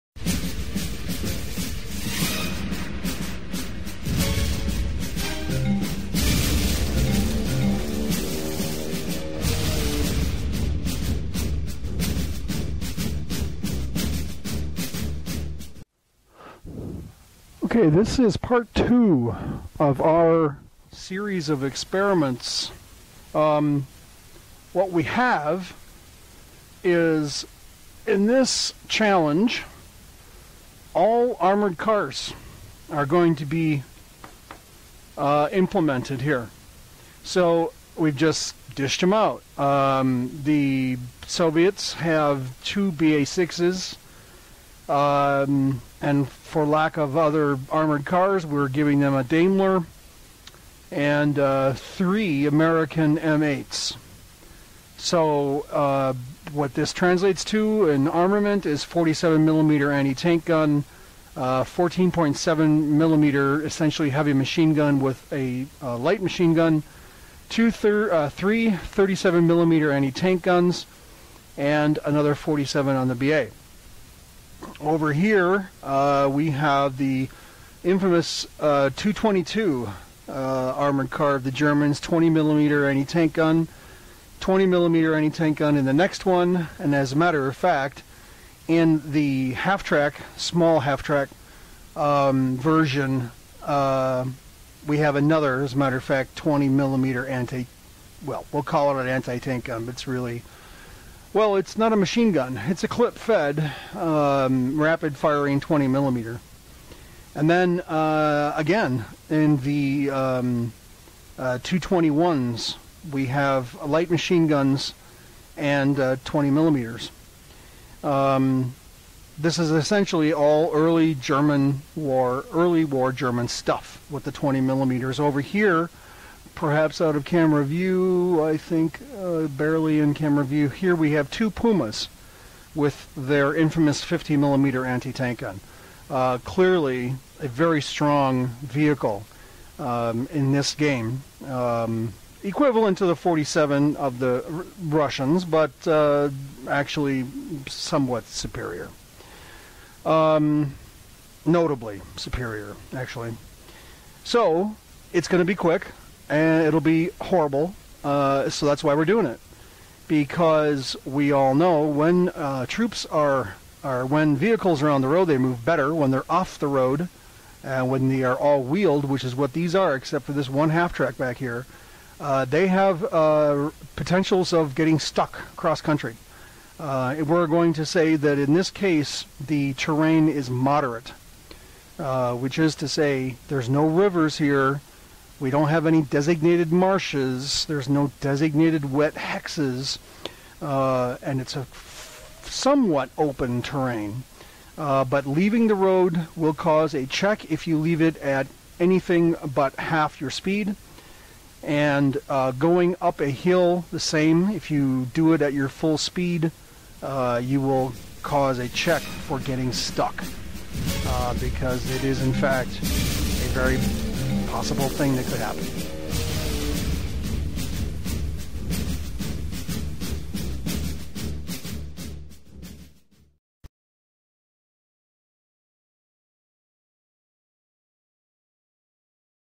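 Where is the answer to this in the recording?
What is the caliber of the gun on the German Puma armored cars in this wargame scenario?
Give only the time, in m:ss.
2:14.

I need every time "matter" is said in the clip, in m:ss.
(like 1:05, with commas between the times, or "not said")
1:27, 1:35.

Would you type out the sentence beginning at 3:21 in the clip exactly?
And uh, going up a hill, the same.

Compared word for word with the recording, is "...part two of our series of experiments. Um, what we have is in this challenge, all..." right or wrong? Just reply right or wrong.
right.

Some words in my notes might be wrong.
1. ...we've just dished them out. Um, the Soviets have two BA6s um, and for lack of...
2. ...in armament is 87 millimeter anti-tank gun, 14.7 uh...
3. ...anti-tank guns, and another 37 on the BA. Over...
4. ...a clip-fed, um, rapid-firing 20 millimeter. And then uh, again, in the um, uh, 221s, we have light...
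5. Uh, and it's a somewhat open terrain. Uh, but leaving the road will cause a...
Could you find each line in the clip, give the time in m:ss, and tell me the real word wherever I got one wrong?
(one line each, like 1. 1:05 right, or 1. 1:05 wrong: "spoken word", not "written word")
1. 0:37 right
2. 0:57 wrong: "47", not "87"
3. 1:09 wrong: "47", not "37"
4. 1:42 right
5. 3:10 right.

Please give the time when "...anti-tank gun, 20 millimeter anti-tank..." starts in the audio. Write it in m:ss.
1:22.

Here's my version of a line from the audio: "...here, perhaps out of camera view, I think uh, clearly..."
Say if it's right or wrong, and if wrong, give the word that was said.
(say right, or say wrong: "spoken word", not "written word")
wrong: "barely", not "clearly".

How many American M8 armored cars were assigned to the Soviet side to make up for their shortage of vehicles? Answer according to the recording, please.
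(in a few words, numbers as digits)
3.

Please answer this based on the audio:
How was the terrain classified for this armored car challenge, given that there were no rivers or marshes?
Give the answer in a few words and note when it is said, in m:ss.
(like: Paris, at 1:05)
moderate, at 3:00.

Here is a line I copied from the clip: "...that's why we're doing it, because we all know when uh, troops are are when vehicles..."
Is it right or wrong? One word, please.
right.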